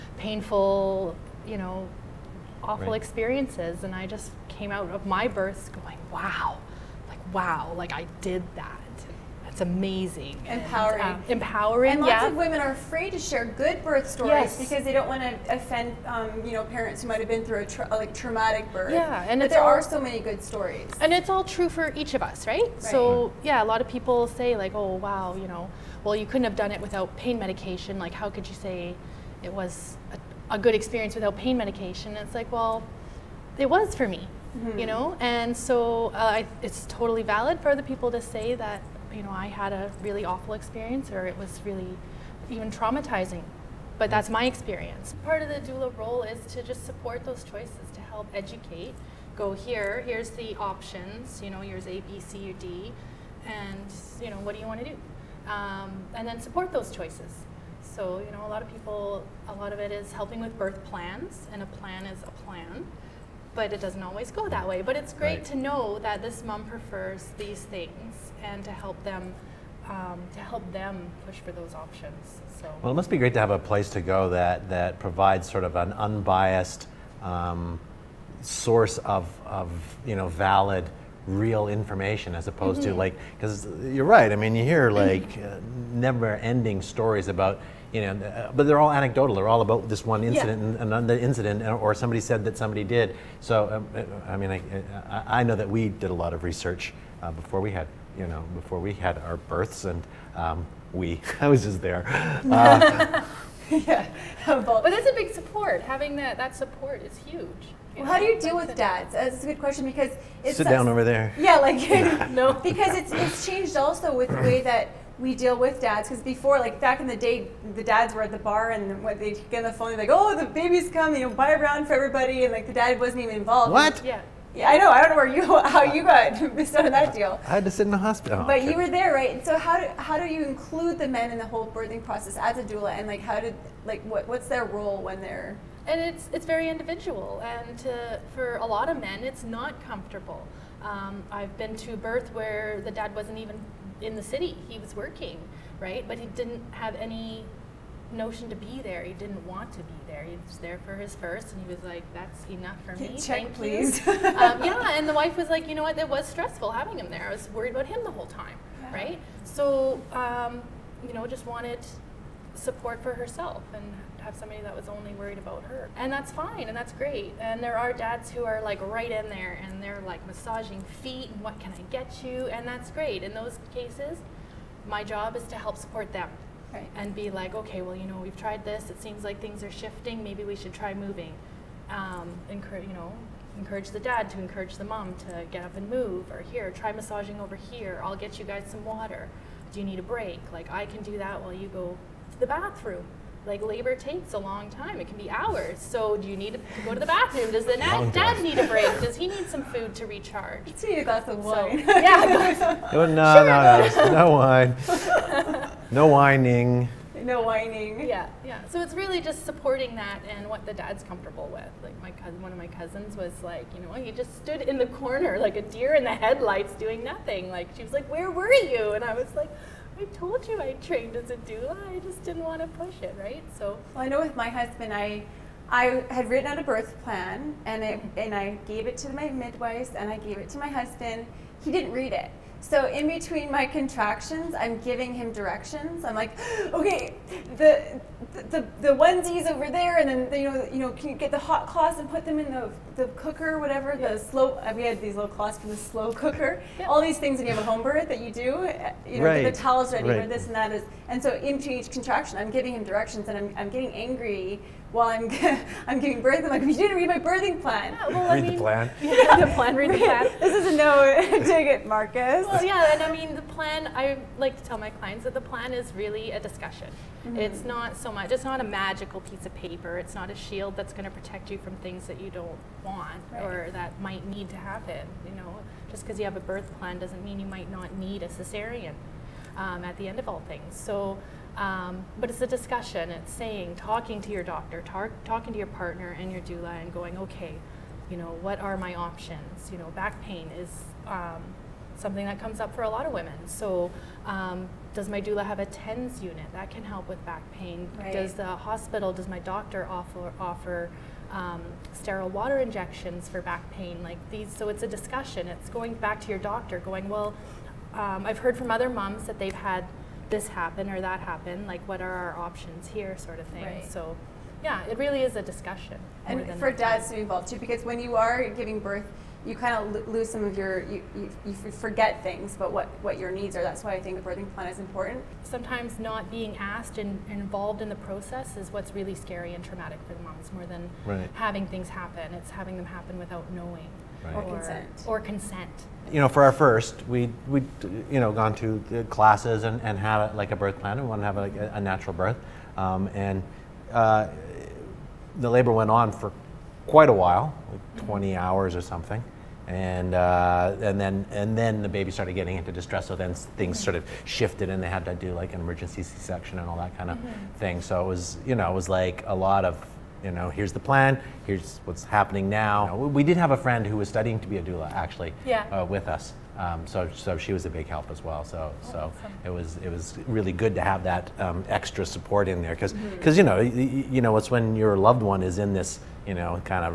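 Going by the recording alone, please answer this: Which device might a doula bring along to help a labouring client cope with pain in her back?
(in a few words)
TENS unit.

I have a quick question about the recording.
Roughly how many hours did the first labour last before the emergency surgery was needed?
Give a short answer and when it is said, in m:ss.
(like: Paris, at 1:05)
20 hours, at 5:48.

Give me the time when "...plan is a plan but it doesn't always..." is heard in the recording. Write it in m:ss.
1:01.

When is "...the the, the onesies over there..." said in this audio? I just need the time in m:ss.
3:57.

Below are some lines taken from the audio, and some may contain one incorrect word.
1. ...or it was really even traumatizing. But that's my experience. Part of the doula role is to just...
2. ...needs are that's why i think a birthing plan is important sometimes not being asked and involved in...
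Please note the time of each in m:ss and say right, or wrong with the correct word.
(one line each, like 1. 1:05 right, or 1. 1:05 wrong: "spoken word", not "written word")
1. 0:41 right
2. 5:23 right.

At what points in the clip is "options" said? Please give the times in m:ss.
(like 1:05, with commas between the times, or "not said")
0:50, 1:11, 4:48, 5:12.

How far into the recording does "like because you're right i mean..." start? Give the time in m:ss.
1:23.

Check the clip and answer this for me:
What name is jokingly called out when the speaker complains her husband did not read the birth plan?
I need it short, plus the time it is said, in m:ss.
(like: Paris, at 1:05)
Marcus, at 4:21.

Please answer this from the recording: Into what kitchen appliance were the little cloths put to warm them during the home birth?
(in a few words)
Slow cooker.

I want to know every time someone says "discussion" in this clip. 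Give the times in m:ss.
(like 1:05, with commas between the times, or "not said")
4:26, 4:42, 5:04, 5:15.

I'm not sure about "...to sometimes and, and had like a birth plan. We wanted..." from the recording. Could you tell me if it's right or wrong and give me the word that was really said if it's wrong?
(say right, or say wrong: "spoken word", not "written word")
wrong: "classes", not "sometimes".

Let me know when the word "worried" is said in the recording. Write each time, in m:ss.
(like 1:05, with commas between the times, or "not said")
2:37, 2:45.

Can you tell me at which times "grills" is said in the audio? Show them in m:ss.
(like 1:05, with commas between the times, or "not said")
not said.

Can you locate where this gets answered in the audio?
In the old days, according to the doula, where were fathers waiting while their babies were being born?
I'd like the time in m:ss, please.
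1:58.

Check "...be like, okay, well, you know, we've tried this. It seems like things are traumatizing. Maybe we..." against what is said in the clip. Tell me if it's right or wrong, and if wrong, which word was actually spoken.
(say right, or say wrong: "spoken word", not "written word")
wrong: "shifting", not "traumatizing".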